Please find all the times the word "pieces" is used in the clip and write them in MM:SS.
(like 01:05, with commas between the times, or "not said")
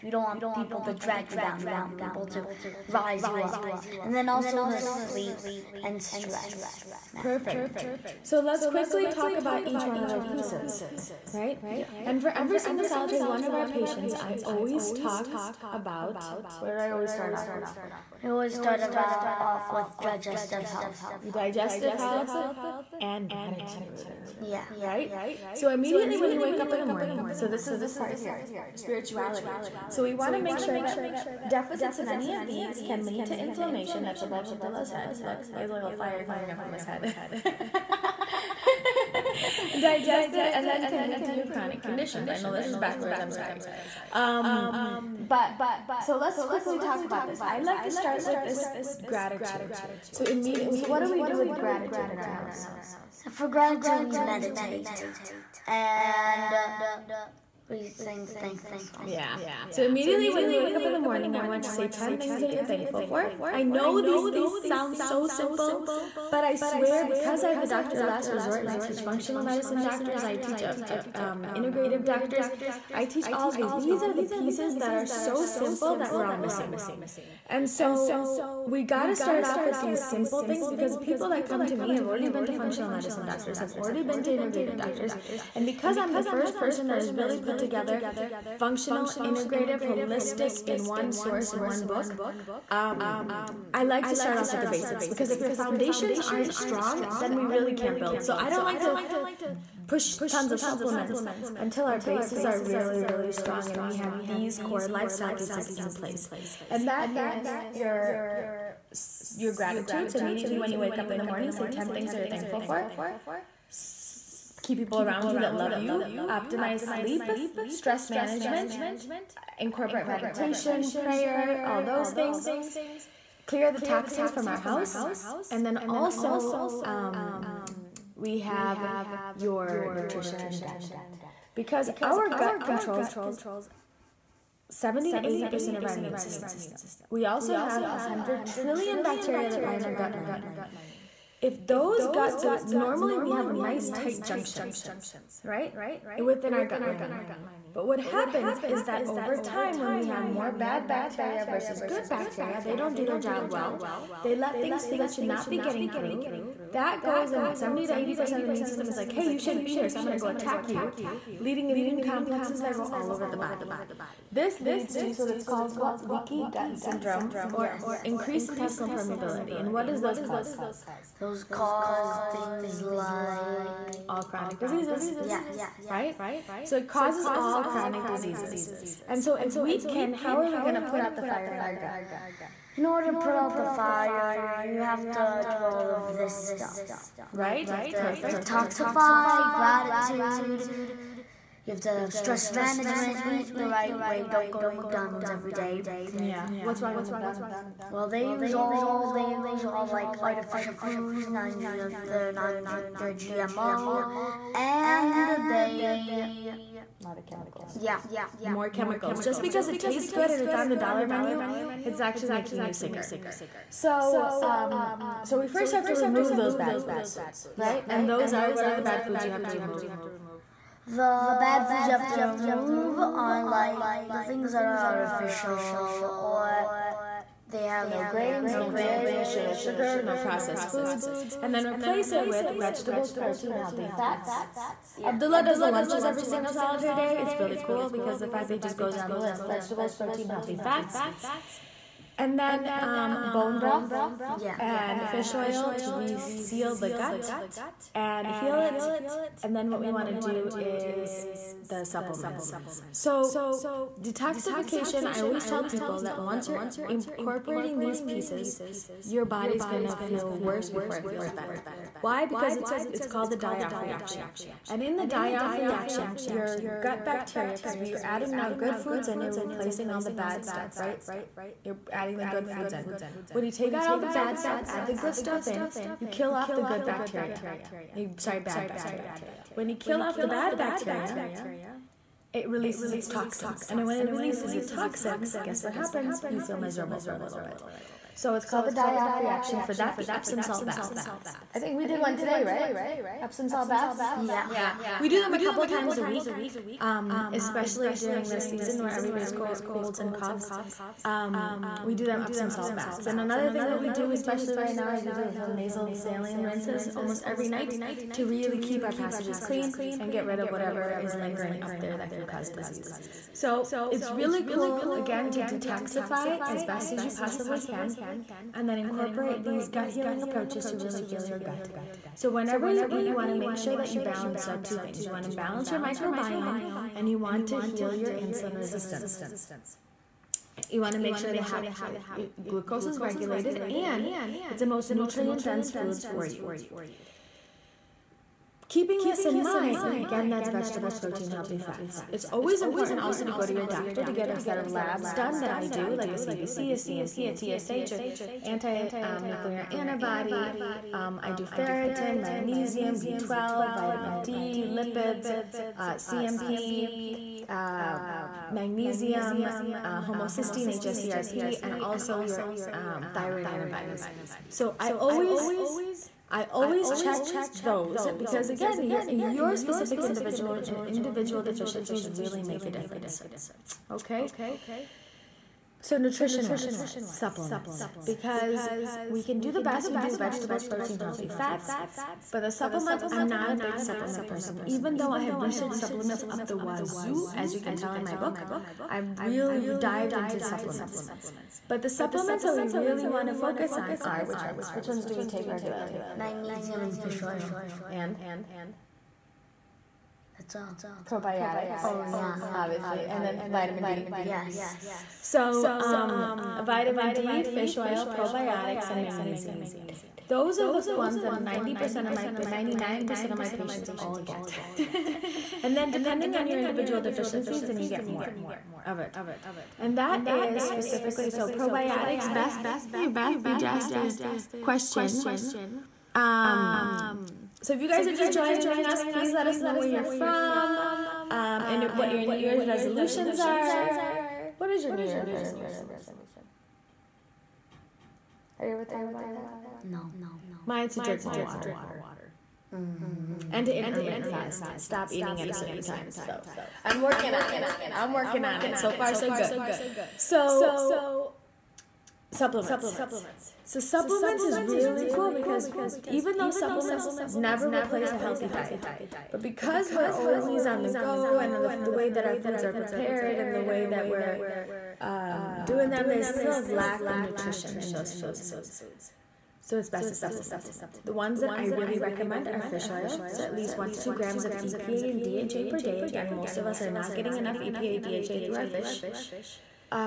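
00:10, 01:14, 01:45, 04:18.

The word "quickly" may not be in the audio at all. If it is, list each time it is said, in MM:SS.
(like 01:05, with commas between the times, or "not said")
00:08, 00:46.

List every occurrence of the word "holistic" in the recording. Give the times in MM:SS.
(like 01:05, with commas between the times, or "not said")
01:29.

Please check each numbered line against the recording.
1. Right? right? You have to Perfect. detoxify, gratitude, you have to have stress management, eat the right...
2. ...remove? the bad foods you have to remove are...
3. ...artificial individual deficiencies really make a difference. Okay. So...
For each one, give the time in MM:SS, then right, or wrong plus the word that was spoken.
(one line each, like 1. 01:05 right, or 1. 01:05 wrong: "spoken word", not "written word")
1. 03:07 right
2. 03:39 right
3. 06:10 wrong: "individual", not "artificial".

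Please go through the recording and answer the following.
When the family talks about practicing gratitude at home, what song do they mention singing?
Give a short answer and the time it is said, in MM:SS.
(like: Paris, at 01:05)
The thankful song, at 00:58.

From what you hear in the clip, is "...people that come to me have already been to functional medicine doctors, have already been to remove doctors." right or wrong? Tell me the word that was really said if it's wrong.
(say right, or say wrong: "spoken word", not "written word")
wrong: "integrative", not "remove".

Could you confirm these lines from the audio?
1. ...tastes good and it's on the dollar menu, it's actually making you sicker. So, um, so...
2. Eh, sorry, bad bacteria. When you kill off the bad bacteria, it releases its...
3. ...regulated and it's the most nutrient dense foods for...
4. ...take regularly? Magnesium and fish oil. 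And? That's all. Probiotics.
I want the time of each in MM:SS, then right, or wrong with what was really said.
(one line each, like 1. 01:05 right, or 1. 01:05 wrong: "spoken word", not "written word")
1. 03:29 right
2. 04:37 right
3. 05:32 right
4. 06:35 right.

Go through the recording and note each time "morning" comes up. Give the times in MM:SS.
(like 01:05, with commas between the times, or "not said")
00:26, 01:00, 01:51.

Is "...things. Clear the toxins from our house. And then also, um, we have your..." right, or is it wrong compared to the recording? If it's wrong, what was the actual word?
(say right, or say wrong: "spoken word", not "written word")
right.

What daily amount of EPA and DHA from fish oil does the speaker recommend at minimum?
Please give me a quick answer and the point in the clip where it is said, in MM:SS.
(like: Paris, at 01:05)
1 to 2 grams, at 07:53.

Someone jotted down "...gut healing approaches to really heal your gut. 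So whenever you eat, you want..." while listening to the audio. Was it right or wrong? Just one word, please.
right.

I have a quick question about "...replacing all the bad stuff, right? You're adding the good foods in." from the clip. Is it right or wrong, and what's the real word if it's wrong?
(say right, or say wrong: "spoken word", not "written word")
right.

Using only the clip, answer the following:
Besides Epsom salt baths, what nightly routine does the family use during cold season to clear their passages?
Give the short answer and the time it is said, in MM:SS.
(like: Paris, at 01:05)
Nasal saline rinses, at 05:05.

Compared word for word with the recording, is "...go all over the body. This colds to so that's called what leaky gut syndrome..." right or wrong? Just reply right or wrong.
wrong.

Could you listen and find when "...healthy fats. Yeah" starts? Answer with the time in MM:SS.
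03:53.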